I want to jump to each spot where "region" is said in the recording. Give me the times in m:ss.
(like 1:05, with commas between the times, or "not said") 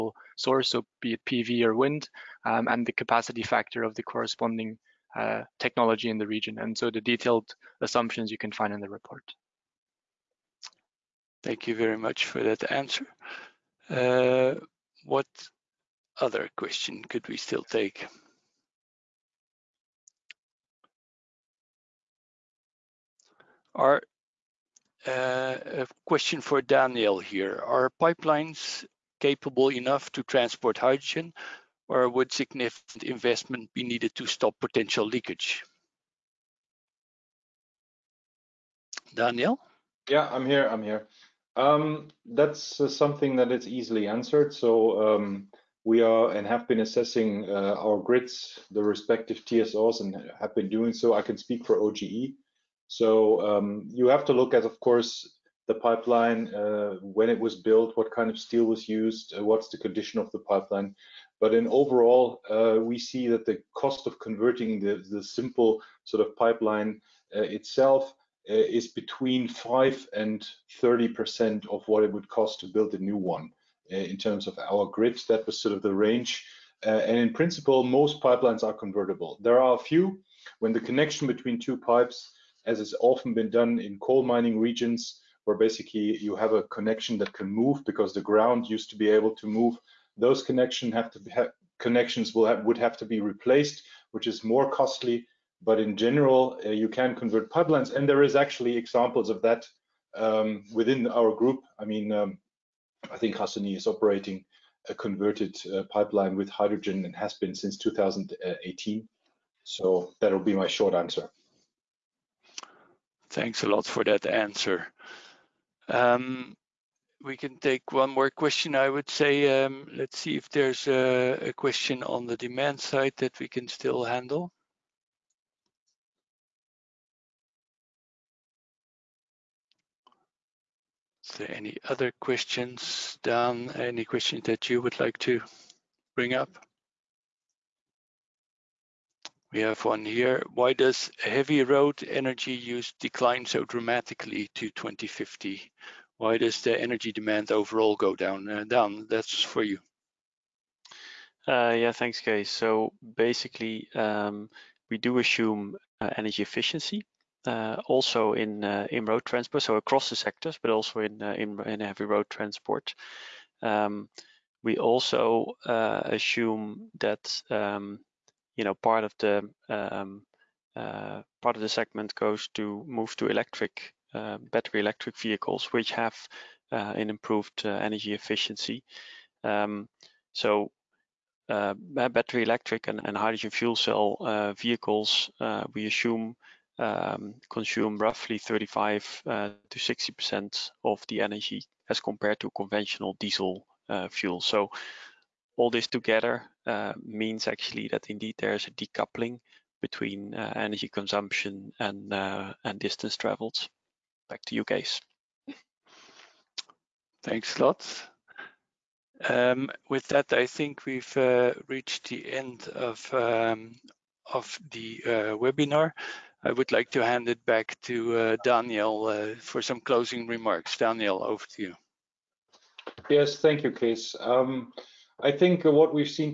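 0:06, 1:24.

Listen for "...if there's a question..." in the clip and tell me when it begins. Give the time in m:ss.
2:00.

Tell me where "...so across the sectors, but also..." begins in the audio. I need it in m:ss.
2:39.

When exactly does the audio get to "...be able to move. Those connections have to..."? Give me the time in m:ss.
1:28.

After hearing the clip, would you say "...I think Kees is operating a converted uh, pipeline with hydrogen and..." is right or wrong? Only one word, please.
wrong.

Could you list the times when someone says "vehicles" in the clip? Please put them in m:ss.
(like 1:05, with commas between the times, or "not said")
2:55, 3:04.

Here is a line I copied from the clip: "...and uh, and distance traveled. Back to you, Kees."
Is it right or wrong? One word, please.
right.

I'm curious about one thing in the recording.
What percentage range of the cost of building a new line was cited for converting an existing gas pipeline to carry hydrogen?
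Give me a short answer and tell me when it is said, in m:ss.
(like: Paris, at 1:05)
5 to 30%, at 1:08.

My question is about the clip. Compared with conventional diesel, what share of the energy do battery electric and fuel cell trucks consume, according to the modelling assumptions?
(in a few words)
35 to 60 percent.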